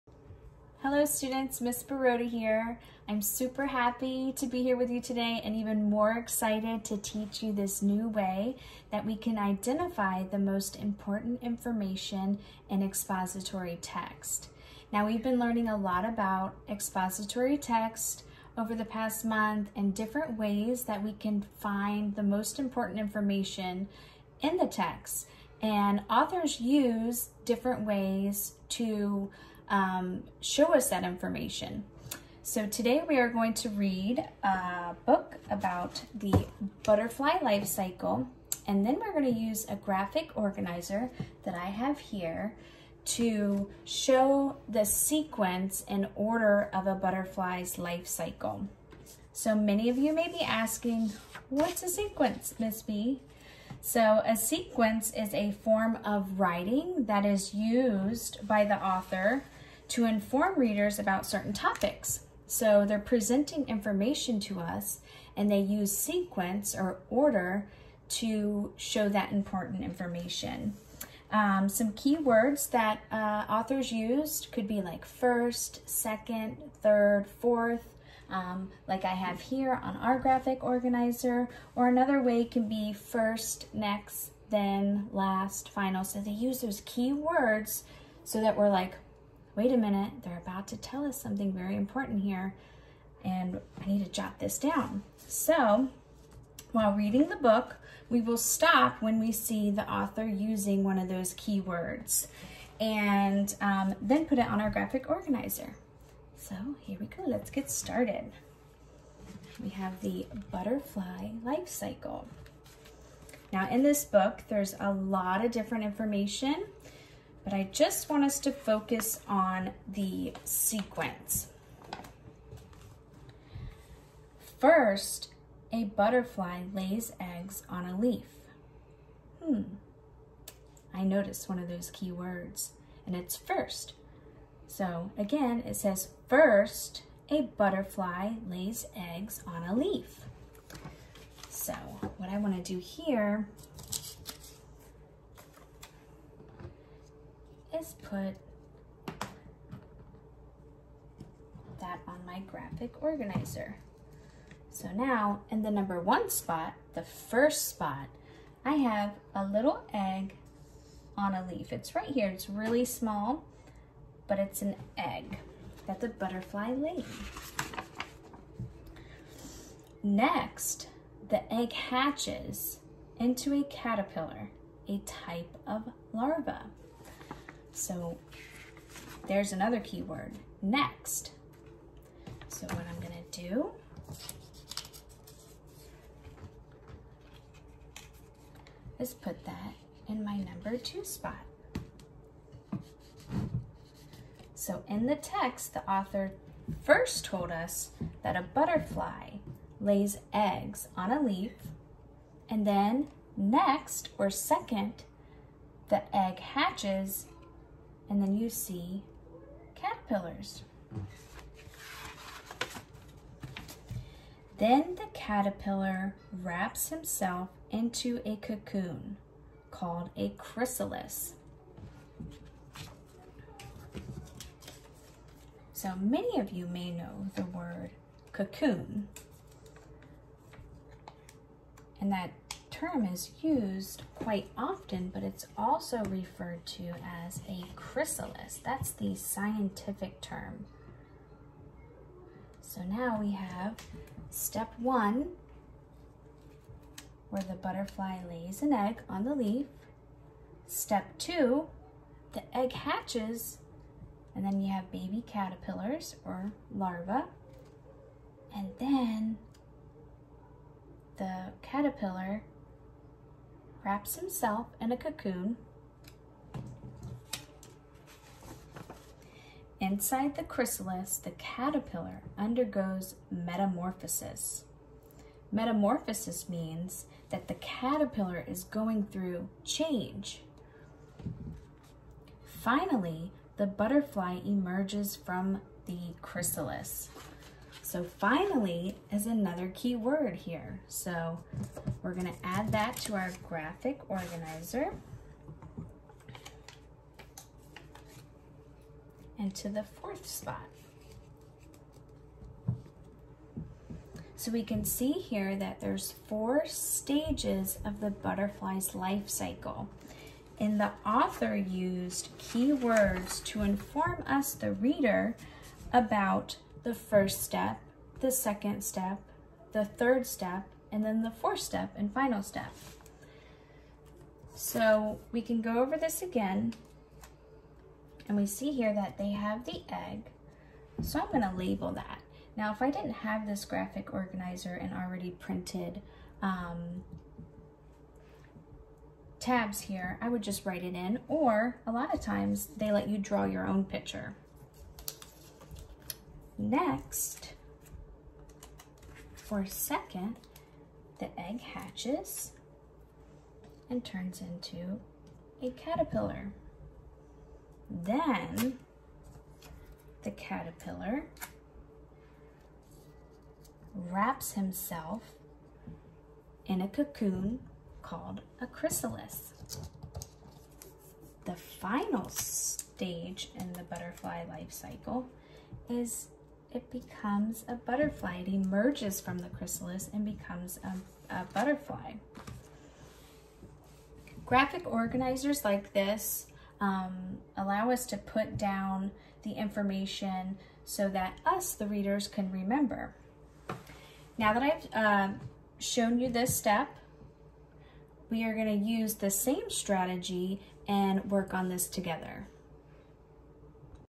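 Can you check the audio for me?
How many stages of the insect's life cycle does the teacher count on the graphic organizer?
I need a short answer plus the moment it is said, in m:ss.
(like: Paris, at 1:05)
4, at 5:06.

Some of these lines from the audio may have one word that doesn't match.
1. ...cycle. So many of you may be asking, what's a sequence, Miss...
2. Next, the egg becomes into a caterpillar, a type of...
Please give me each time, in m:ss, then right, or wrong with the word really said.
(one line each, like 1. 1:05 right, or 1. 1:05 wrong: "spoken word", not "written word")
1. 0:48 right
2. 2:50 wrong: "hatches", not "becomes".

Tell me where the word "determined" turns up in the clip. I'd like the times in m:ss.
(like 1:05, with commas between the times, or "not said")
not said.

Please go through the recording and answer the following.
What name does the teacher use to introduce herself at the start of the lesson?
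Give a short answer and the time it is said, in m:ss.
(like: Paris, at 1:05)
Miss Borota, at 0:01.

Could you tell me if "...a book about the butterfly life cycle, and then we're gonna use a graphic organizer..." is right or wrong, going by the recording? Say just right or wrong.
right.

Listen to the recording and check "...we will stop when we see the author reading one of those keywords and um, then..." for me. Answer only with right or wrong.
wrong.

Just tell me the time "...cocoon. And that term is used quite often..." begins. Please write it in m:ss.
3:48.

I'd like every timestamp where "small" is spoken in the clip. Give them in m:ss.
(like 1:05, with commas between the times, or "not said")
2:42.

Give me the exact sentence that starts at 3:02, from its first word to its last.
So what I'm gonna do, is put that in my number two spot.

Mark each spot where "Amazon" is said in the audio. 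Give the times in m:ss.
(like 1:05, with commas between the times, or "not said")
not said.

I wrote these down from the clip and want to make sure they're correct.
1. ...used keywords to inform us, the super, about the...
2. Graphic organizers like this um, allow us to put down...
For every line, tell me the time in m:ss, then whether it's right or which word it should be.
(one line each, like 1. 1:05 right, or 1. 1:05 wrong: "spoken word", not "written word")
1. 5:11 wrong: "reader", not "super"
2. 6:24 right.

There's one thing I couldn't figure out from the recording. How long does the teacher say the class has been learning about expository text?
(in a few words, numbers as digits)
past month.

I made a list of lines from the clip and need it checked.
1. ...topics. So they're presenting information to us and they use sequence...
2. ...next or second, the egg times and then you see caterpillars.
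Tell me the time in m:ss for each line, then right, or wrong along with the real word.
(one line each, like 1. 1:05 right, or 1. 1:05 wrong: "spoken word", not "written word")
1. 1:01 right
2. 3:23 wrong: "hatches", not "times".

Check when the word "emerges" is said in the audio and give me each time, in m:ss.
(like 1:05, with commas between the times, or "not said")
4:44, 6:18.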